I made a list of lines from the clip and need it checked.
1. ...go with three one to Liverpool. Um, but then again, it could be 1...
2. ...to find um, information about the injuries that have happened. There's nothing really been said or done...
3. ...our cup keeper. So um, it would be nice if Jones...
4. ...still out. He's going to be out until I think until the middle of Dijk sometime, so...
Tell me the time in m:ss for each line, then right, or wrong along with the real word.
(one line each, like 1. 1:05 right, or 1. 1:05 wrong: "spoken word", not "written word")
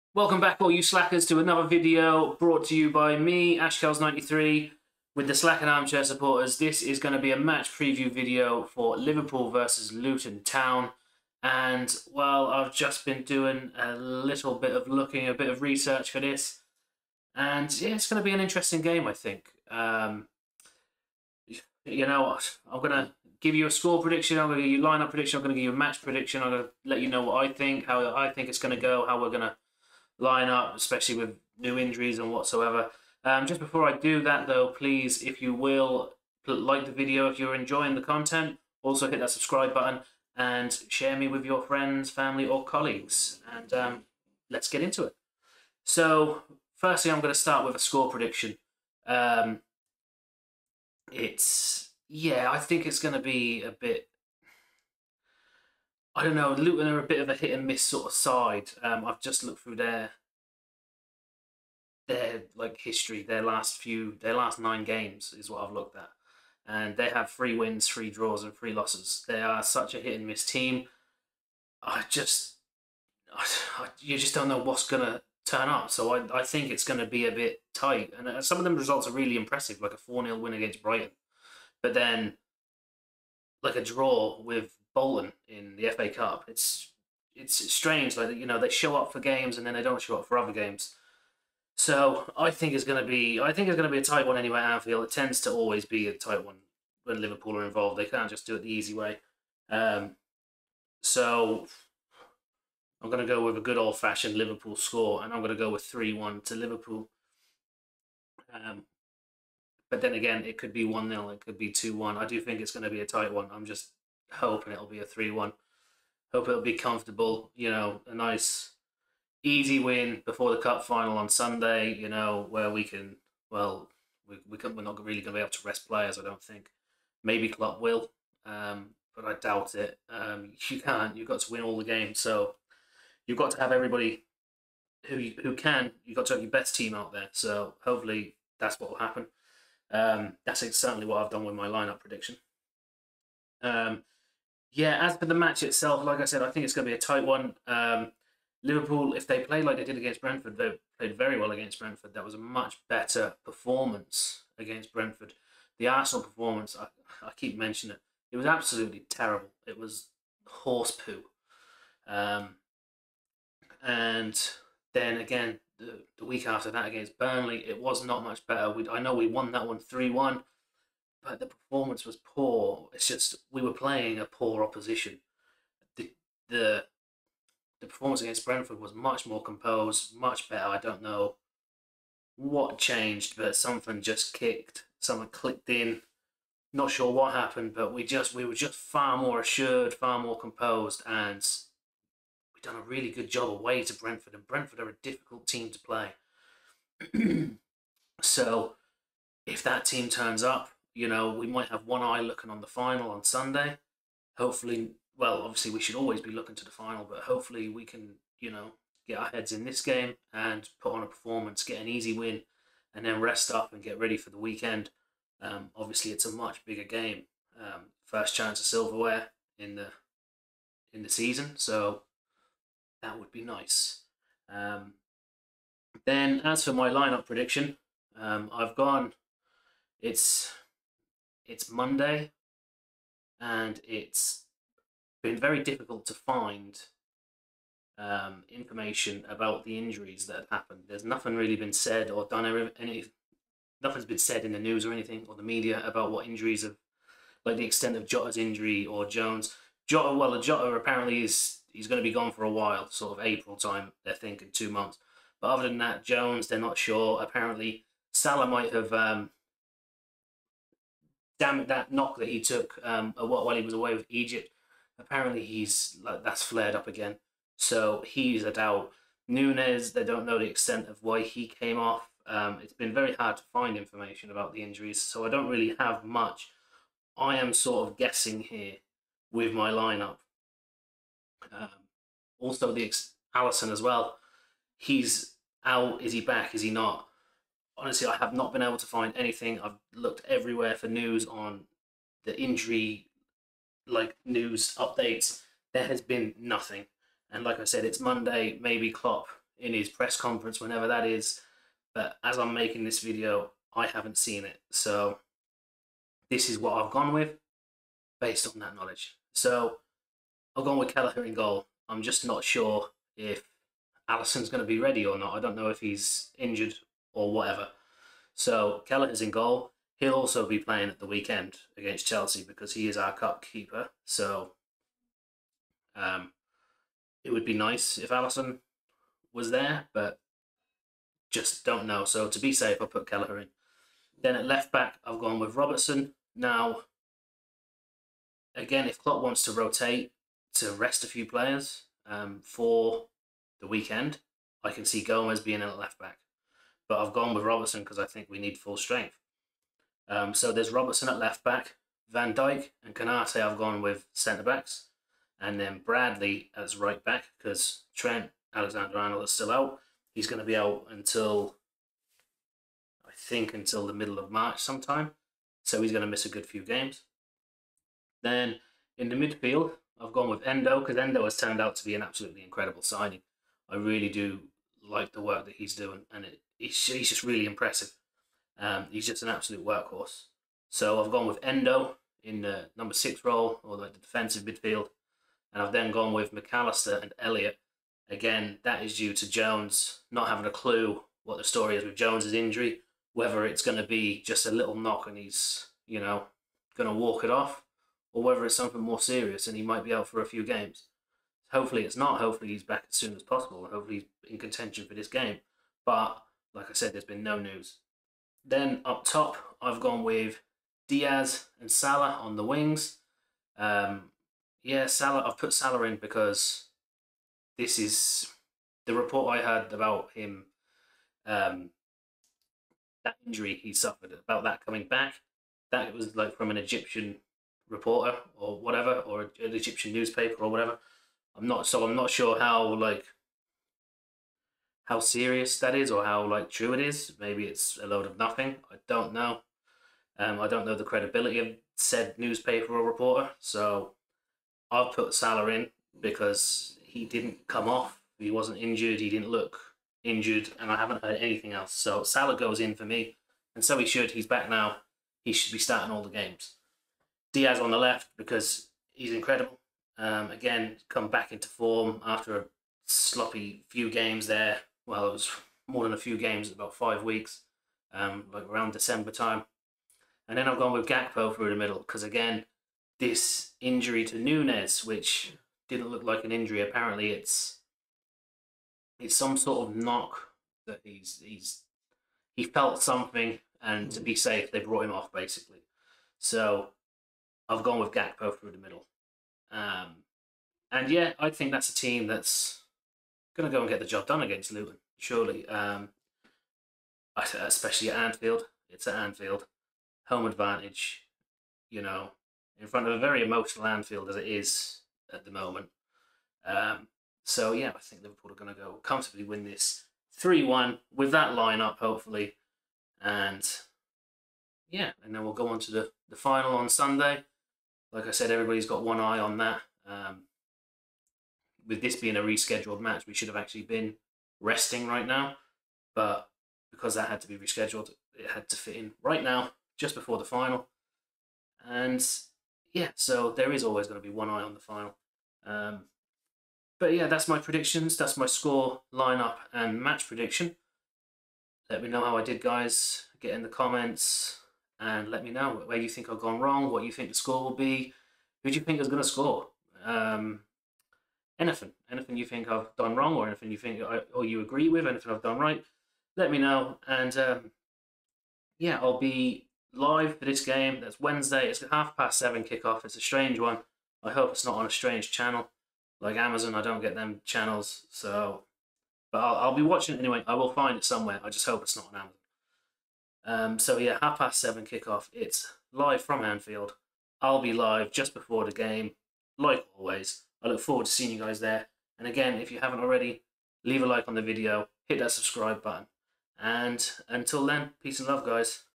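1. 1:45 right
2. 3:56 right
3. 5:22 wrong: "Alisson", not "Jones"
4. 5:59 wrong: "March", not "Dijk".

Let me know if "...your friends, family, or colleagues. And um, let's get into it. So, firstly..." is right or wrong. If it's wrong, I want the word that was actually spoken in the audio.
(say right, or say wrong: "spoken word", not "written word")
right.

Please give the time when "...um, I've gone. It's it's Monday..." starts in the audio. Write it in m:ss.
3:48.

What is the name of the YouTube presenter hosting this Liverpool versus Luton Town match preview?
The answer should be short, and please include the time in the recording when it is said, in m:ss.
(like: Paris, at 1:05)
Ashkels93, at 0:03.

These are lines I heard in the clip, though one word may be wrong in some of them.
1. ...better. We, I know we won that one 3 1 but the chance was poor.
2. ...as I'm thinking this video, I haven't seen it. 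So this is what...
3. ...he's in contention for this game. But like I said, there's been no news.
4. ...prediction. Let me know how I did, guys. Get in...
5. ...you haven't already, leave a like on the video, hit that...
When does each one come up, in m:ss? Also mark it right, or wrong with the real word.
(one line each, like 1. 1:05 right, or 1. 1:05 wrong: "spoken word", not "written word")
1. 2:48 wrong: "performance", not "chance"
2. 5:02 wrong: "making", not "thinking"
3. 6:44 right
4. 9:00 right
5. 9:42 right.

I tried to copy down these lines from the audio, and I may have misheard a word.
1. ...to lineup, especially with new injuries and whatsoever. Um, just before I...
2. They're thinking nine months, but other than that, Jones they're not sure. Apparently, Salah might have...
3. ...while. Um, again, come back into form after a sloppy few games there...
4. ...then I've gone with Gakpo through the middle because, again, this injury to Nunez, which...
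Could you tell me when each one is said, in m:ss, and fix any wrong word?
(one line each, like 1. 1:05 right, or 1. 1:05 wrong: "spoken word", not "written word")
1. 0:29 right
2. 4:14 wrong: "two", not "nine"
3. 7:39 wrong: "incredible", not "while"
4. 7:50 right.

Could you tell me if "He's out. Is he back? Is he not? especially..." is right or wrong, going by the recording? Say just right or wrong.
wrong.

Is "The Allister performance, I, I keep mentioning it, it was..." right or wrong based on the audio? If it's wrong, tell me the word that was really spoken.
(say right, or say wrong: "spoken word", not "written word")
wrong: "Arsenal", not "Allister".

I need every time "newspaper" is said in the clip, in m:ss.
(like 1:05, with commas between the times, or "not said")
7:09, 7:22.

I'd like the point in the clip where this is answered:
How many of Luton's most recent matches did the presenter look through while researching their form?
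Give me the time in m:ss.
1:04.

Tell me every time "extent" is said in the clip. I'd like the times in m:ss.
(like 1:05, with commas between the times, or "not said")
4:07, 4:30.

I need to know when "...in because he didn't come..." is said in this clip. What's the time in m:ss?
7:25.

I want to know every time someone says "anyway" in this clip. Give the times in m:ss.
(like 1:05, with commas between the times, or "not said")
1:34, 9:29.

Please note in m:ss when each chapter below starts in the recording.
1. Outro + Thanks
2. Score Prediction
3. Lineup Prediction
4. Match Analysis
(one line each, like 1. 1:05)
1. 9:01
2. 0:45
3. 3:45
4. 2:24.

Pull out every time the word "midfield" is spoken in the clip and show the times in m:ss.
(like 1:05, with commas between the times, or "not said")
6:09, 6:24.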